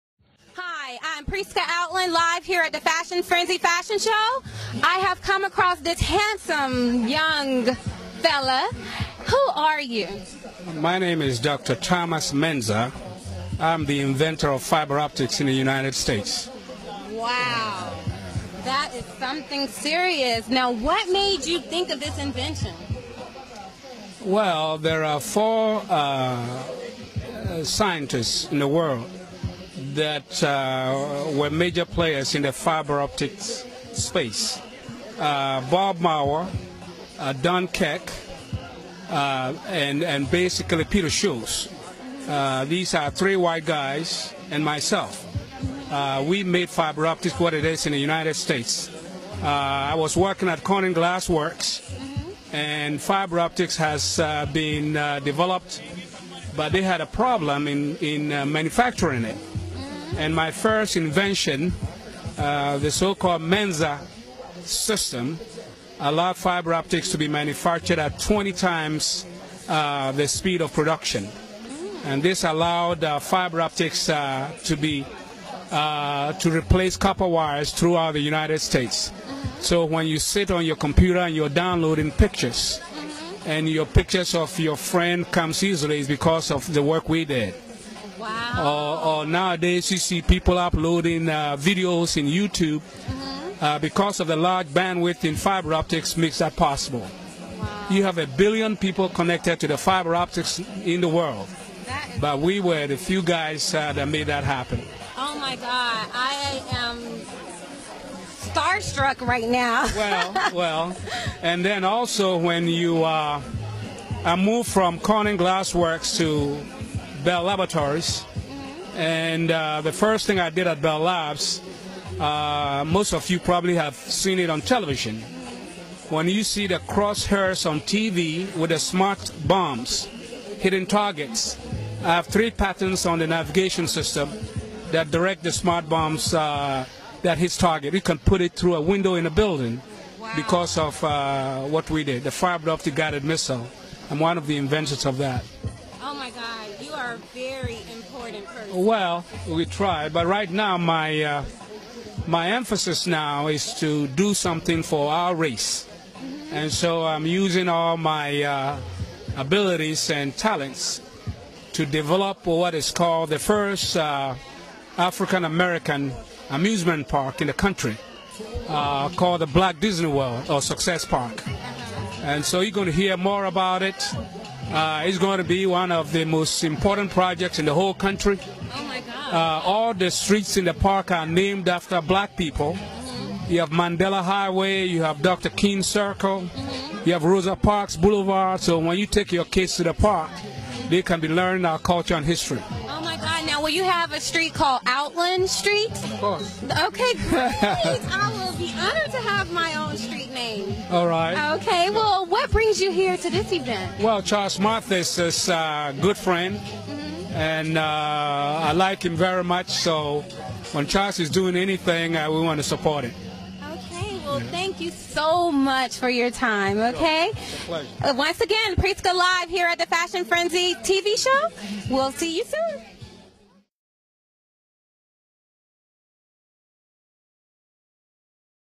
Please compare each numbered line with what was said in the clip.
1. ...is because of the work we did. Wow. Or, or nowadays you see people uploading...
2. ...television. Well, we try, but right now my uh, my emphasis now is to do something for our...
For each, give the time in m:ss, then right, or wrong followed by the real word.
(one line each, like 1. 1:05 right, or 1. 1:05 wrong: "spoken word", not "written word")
1. 1:25 right
2. 2:28 wrong: "person", not "television".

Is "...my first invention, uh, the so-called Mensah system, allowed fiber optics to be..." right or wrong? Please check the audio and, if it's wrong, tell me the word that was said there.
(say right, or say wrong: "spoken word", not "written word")
right.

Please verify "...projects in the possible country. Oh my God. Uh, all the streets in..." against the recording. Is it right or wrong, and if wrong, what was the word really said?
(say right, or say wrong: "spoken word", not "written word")
wrong: "whole", not "possible".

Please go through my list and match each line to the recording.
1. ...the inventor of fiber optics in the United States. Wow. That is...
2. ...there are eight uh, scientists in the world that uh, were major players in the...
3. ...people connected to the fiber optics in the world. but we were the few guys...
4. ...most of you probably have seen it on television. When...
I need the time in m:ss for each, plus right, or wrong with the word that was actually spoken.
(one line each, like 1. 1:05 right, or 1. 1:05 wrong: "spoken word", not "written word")
1. 0:13 right
2. 0:24 wrong: "four", not "eight"
3. 1:38 right
4. 2:02 right.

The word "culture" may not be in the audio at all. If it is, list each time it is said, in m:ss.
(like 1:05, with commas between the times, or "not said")
3:11.